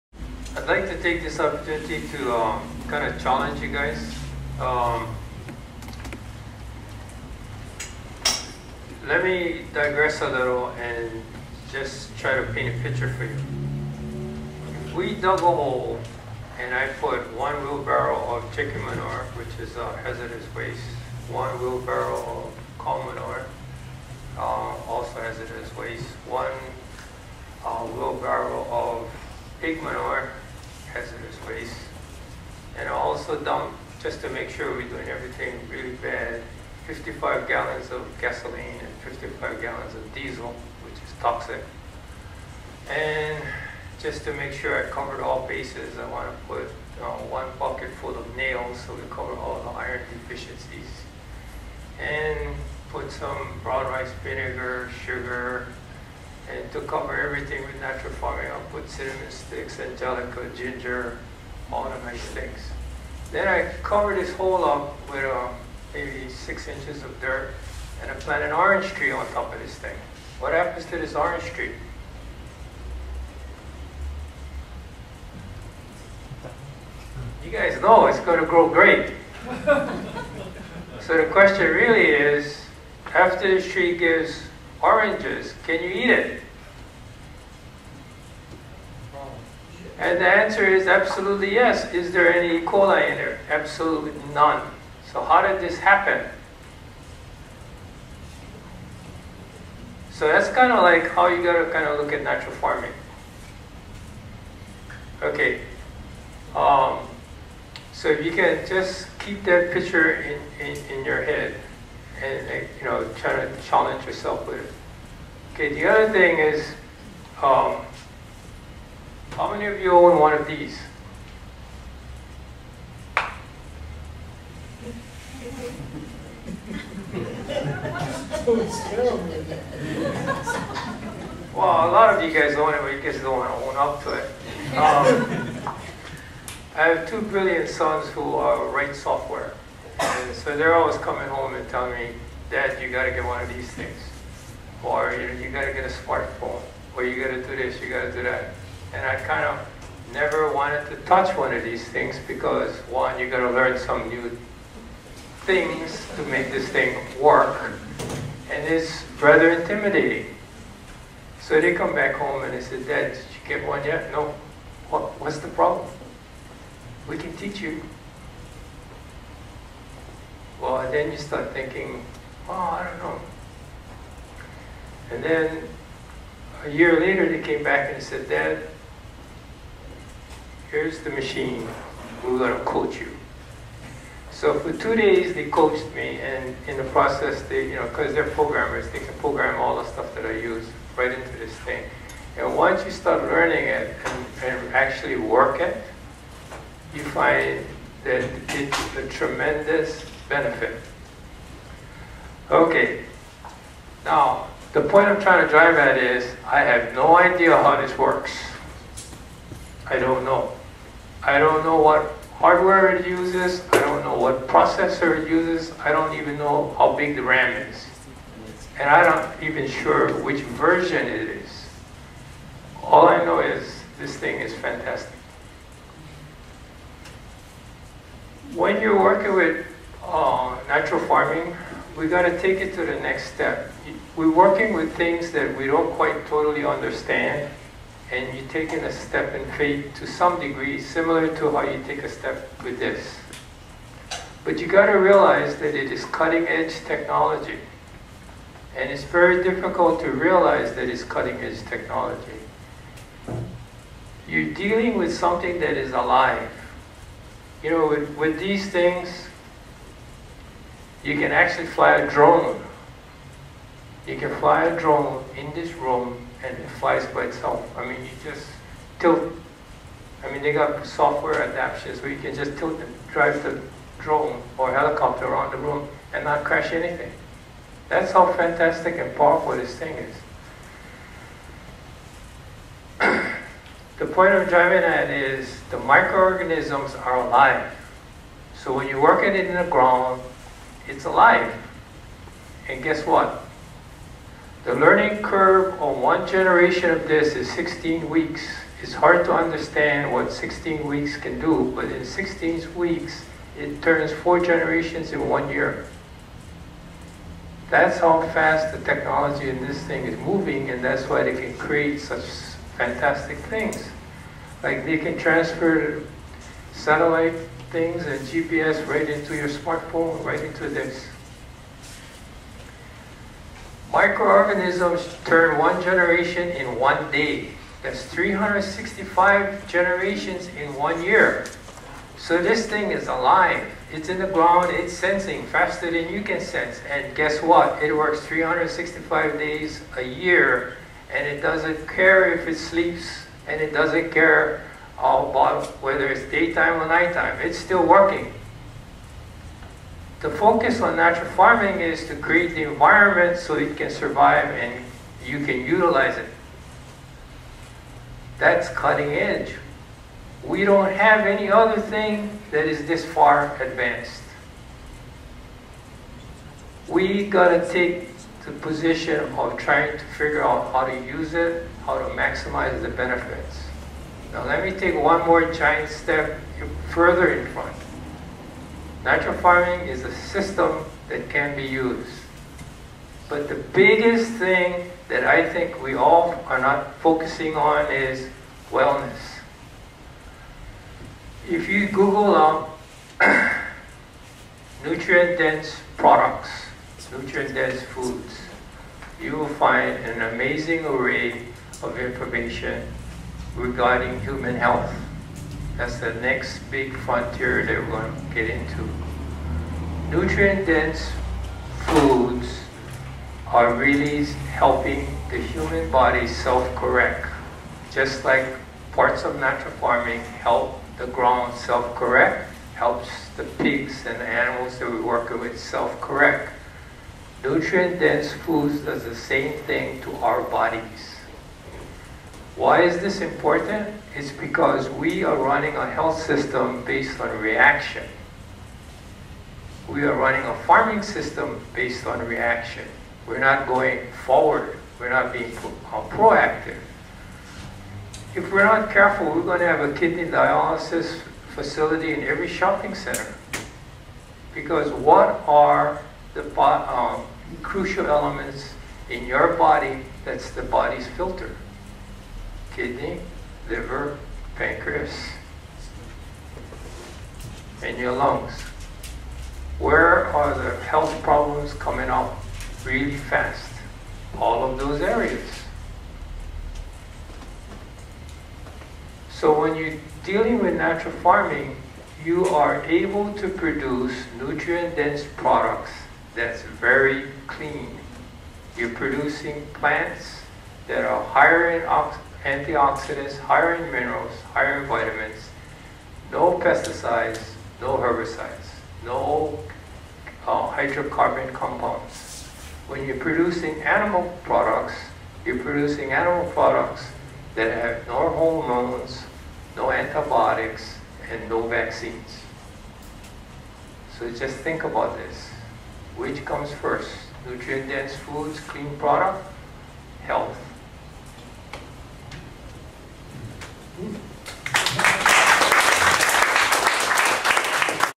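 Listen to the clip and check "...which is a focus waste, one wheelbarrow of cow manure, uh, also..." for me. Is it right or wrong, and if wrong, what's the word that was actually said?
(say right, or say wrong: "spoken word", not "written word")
wrong: "hazardous", not "focus".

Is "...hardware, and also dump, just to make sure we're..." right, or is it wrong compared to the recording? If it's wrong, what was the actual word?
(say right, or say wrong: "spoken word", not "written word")
wrong: "manure", not "hardware".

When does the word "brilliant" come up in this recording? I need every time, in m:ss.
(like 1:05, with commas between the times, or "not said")
2:17.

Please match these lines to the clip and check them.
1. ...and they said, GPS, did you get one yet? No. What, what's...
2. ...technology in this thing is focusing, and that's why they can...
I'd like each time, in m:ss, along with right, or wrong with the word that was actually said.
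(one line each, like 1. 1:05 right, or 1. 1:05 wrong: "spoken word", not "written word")
1. 2:42 wrong: "Dad", not "GPS"
2. 5:08 wrong: "moving", not "focusing".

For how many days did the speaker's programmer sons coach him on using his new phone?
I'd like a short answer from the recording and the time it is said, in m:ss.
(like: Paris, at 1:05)
2, at 3:04.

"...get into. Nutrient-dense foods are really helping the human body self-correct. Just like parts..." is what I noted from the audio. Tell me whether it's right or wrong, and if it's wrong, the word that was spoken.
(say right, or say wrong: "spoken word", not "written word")
right.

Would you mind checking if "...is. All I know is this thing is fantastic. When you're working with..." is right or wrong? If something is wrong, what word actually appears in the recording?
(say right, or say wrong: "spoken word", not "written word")
right.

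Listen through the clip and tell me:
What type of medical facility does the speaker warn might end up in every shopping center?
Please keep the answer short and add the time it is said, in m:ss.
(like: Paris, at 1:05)
Kidney dialysis facility, at 7:29.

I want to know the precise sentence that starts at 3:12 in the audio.
And once you start learning it and, and actually work it, you find that it's a tremendous benefit.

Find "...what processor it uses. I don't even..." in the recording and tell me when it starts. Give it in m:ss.
3:34.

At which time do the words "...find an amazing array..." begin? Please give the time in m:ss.
6:39.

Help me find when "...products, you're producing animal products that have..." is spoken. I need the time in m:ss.
8:24.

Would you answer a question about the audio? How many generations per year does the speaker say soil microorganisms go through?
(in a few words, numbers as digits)
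365.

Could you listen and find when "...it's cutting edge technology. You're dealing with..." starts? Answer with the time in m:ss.
4:10.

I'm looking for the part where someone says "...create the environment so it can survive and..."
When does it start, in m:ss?
5:52.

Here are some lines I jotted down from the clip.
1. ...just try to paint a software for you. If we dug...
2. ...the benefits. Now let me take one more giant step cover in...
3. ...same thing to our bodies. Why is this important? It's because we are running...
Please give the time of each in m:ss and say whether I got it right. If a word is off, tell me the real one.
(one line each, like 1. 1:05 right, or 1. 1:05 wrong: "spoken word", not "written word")
1. 0:11 wrong: "picture", not "software"
2. 6:12 wrong: "further", not "cover"
3. 7:09 right.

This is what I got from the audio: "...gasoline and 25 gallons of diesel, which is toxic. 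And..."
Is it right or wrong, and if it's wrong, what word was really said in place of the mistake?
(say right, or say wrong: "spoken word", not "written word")
wrong: "55", not "25".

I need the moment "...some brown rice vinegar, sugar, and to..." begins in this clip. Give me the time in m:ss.
0:53.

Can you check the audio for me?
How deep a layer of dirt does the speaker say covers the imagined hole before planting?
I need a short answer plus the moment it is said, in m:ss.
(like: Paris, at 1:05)
6 inches, at 1:06.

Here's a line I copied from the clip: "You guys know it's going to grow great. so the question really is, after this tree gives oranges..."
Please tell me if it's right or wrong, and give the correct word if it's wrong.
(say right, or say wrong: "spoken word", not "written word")
right.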